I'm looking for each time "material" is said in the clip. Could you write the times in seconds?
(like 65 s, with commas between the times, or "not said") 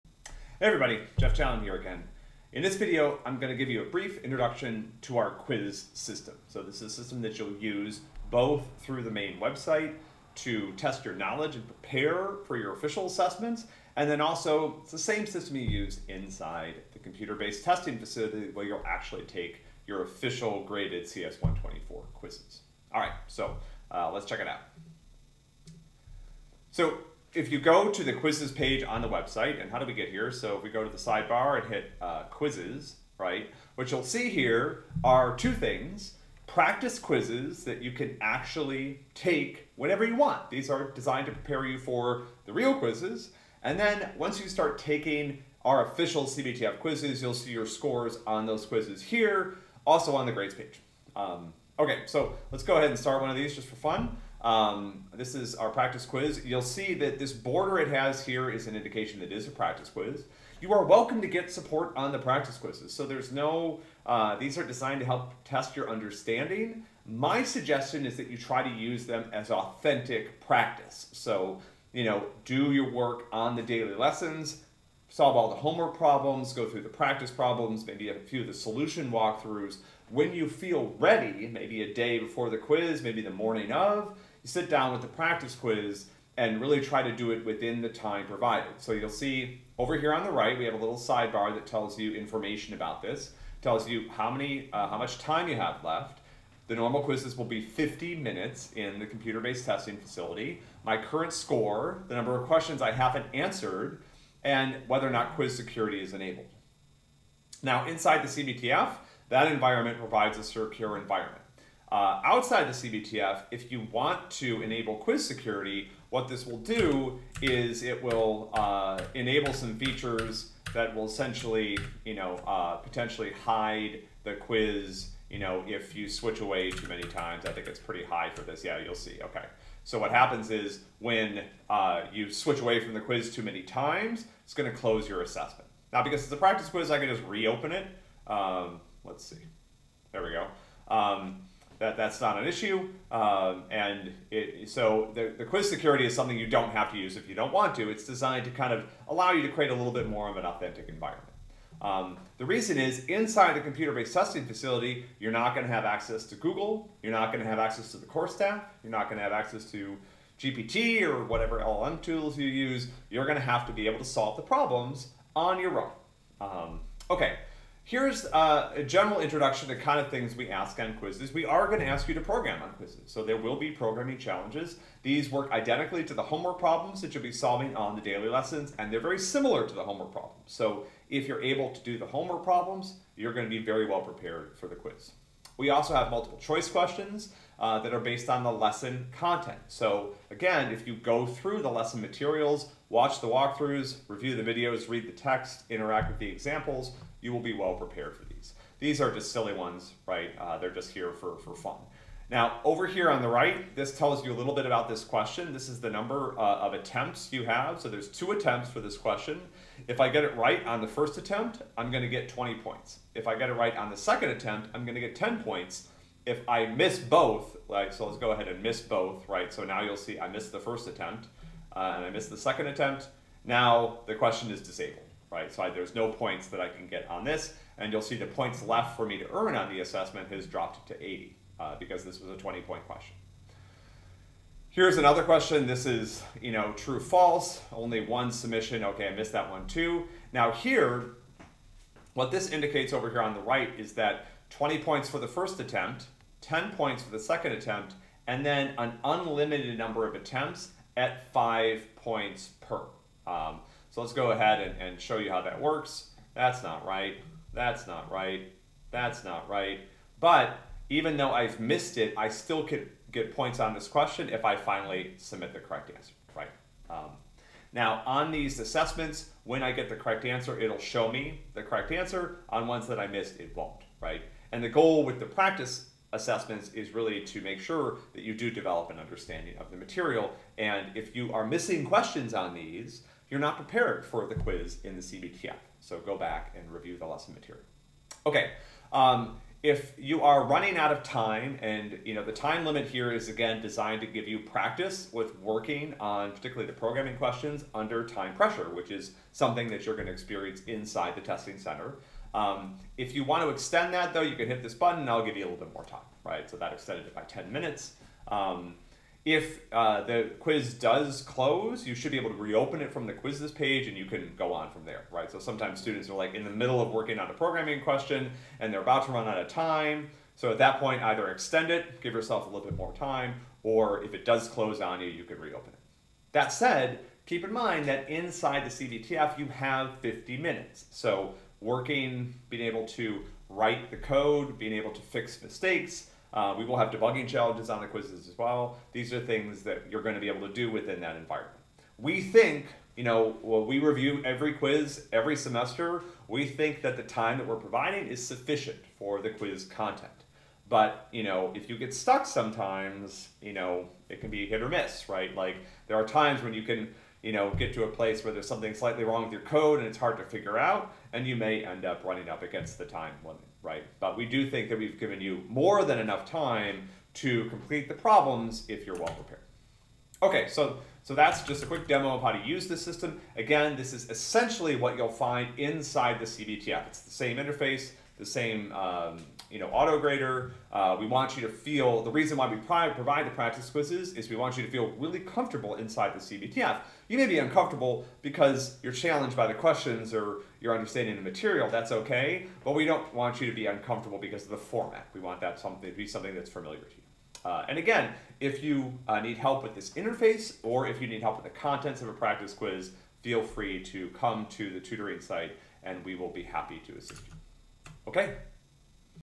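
192 s, 279 s, 287 s, 391 s.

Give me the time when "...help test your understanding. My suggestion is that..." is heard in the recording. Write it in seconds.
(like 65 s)
65 s.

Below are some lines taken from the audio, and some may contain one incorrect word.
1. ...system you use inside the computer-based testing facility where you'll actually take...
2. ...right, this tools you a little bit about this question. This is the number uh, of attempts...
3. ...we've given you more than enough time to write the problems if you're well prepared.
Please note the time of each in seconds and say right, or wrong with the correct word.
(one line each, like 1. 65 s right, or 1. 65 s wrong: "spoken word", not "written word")
1. 15 s right
2. 203 s wrong: "tells", not "tools"
3. 364 s wrong: "complete", not "write".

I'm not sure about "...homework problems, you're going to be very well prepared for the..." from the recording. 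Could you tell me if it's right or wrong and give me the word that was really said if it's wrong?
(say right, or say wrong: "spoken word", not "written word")
right.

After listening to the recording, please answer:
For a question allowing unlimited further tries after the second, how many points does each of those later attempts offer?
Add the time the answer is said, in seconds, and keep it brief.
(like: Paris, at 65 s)
5, at 251 s.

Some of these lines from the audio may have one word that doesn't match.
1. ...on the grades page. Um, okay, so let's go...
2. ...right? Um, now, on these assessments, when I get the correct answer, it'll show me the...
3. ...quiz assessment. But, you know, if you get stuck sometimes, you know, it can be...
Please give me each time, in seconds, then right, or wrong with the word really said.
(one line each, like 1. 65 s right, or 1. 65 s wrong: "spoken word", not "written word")
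1. 50 s right
2. 266 s right
3. 349 s wrong: "content", not "assessment".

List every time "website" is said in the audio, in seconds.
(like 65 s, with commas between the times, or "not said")
9 s, 29 s.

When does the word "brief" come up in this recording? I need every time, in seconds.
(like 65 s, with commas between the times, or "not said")
3 s.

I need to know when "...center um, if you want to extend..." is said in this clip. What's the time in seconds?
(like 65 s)
301 s.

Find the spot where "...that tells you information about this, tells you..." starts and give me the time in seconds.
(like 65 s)
91 s.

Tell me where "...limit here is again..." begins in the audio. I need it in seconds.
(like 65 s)
292 s.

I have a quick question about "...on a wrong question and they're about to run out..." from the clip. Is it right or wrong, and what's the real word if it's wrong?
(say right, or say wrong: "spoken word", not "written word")
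wrong: "programming", not "wrong".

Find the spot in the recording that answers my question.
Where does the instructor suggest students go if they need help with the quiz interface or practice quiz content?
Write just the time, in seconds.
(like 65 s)
404 s.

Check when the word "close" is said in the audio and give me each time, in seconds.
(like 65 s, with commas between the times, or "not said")
134 s, 311 s, 324 s.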